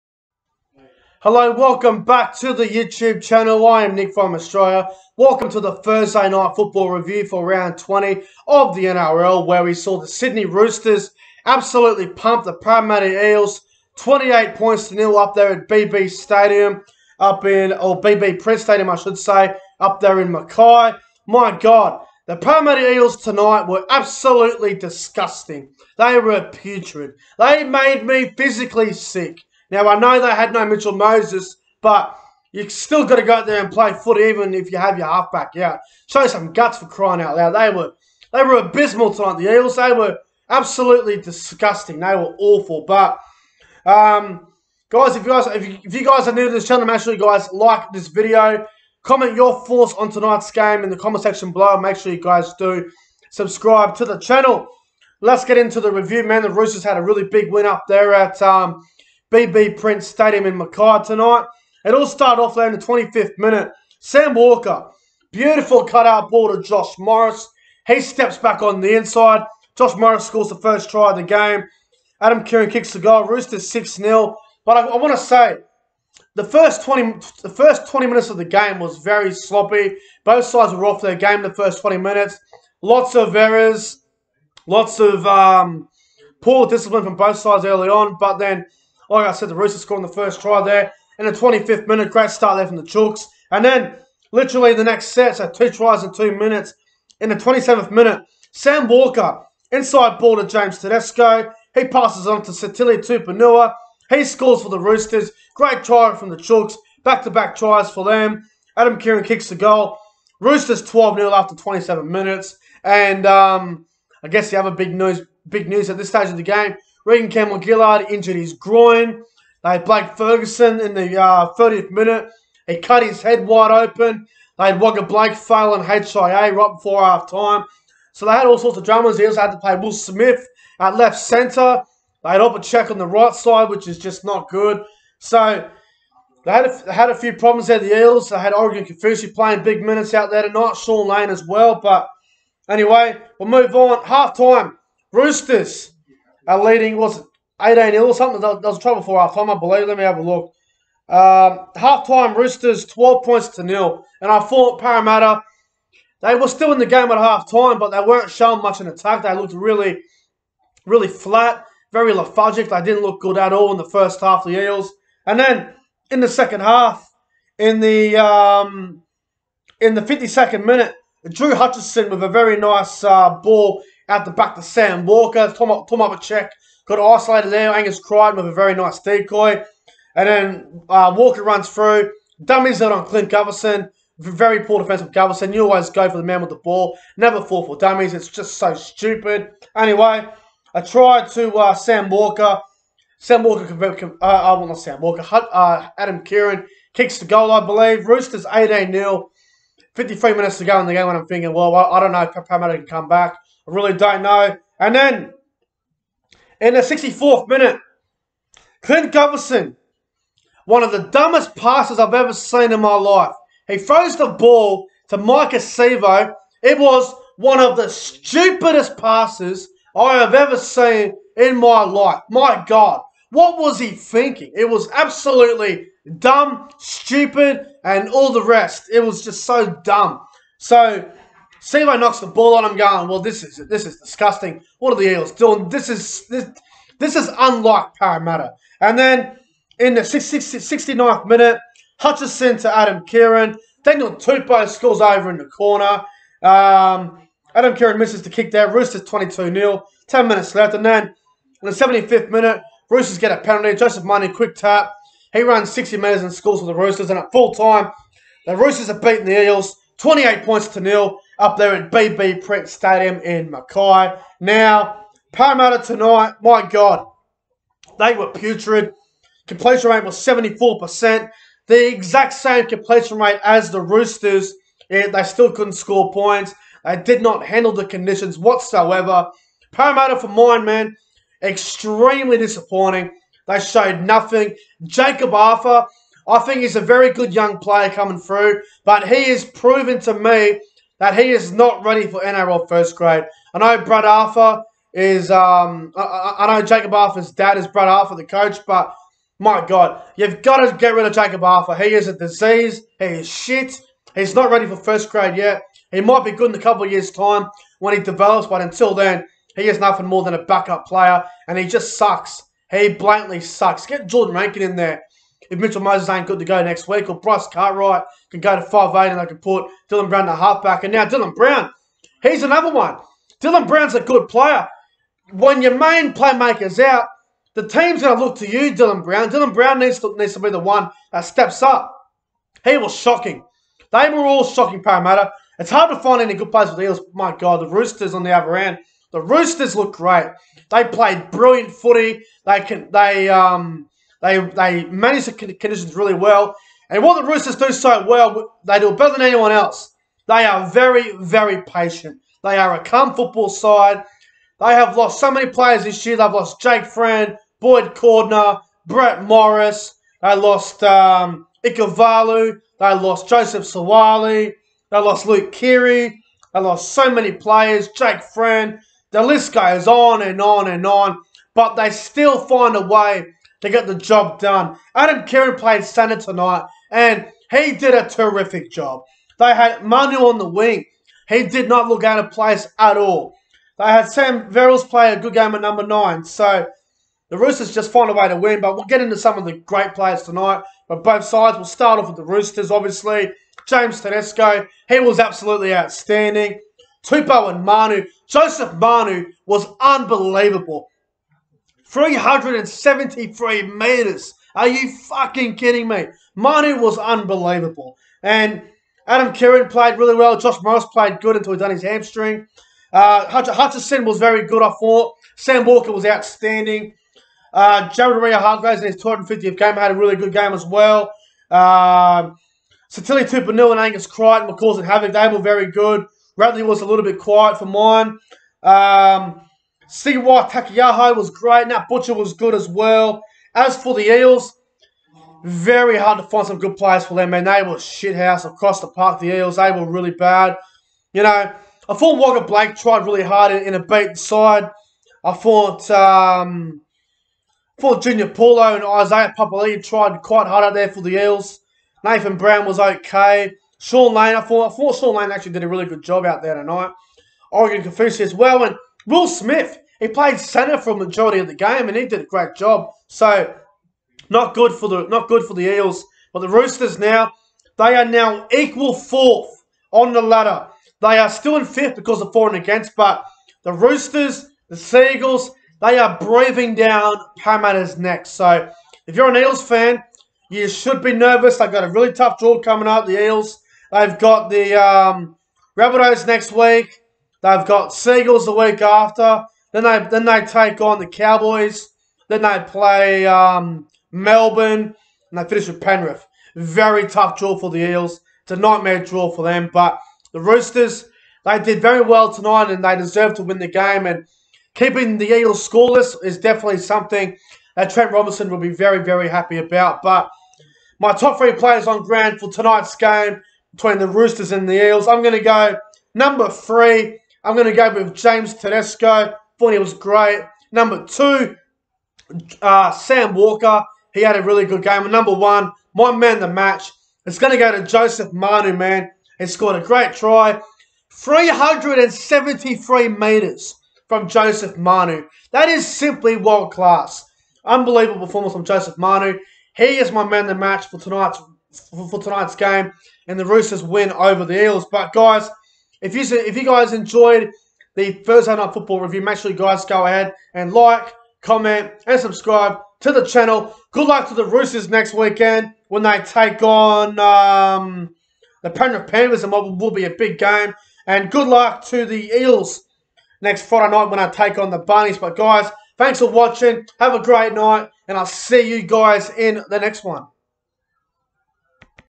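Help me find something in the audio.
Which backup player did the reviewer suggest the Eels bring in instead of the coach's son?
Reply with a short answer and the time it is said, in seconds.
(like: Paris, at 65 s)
Jordan Rankin, at 313 s.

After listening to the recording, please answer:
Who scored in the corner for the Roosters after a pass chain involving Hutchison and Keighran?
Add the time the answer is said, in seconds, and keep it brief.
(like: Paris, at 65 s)
Daniel Tupou, at 243 s.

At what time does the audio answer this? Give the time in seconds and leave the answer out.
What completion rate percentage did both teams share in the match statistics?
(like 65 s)
270 s.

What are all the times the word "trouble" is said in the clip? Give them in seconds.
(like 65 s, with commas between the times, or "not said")
148 s.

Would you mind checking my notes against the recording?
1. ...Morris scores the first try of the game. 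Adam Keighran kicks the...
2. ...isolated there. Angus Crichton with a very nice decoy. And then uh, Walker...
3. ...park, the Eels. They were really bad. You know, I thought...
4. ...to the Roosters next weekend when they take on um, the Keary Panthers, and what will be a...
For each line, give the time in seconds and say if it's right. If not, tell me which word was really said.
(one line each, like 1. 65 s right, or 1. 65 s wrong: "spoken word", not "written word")
1. 69 s right
2. 176 s right
3. 438 s right
4. 554 s wrong: "Penrith", not "Keary".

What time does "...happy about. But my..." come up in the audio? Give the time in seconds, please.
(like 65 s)
509 s.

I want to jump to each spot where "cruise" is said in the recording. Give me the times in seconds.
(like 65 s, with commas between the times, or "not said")
not said.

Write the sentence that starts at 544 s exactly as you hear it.
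But guys, if you if you guys enjoyed the Thursday Night Football review.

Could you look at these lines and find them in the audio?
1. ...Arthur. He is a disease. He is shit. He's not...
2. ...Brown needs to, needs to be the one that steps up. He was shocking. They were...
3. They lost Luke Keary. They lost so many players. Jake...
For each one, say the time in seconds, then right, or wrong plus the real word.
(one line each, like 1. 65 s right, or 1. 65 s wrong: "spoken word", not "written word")
1. 301 s right
2. 329 s right
3. 364 s right.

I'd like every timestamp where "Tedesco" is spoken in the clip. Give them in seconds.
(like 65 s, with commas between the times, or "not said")
100 s, 394 s, 518 s.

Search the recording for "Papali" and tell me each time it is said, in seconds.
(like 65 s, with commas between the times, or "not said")
449 s.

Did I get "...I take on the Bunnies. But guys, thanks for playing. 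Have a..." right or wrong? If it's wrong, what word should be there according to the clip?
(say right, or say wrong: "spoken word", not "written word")
wrong: "watching", not "playing".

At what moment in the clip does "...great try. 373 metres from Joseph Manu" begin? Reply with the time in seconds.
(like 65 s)
529 s.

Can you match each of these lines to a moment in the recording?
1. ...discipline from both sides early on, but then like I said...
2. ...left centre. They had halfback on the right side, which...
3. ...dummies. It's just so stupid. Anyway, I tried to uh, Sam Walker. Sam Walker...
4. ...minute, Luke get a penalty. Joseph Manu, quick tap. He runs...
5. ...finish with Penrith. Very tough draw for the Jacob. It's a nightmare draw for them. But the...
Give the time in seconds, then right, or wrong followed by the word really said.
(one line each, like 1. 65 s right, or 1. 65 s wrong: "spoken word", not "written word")
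1. 86 s right
2. 130 s wrong: "check", not "halfback"
3. 187 s right
4. 252 s wrong: "Roosters", not "Luke"
5. 495 s wrong: "Eels", not "Jacob".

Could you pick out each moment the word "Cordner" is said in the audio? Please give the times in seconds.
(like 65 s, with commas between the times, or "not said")
357 s.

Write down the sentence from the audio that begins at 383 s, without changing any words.
They had Sam Verrills play a good game at number nine.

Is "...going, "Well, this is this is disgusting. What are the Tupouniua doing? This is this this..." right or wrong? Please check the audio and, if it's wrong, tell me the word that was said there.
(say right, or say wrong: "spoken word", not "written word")
wrong: "Eels", not "Tupouniua".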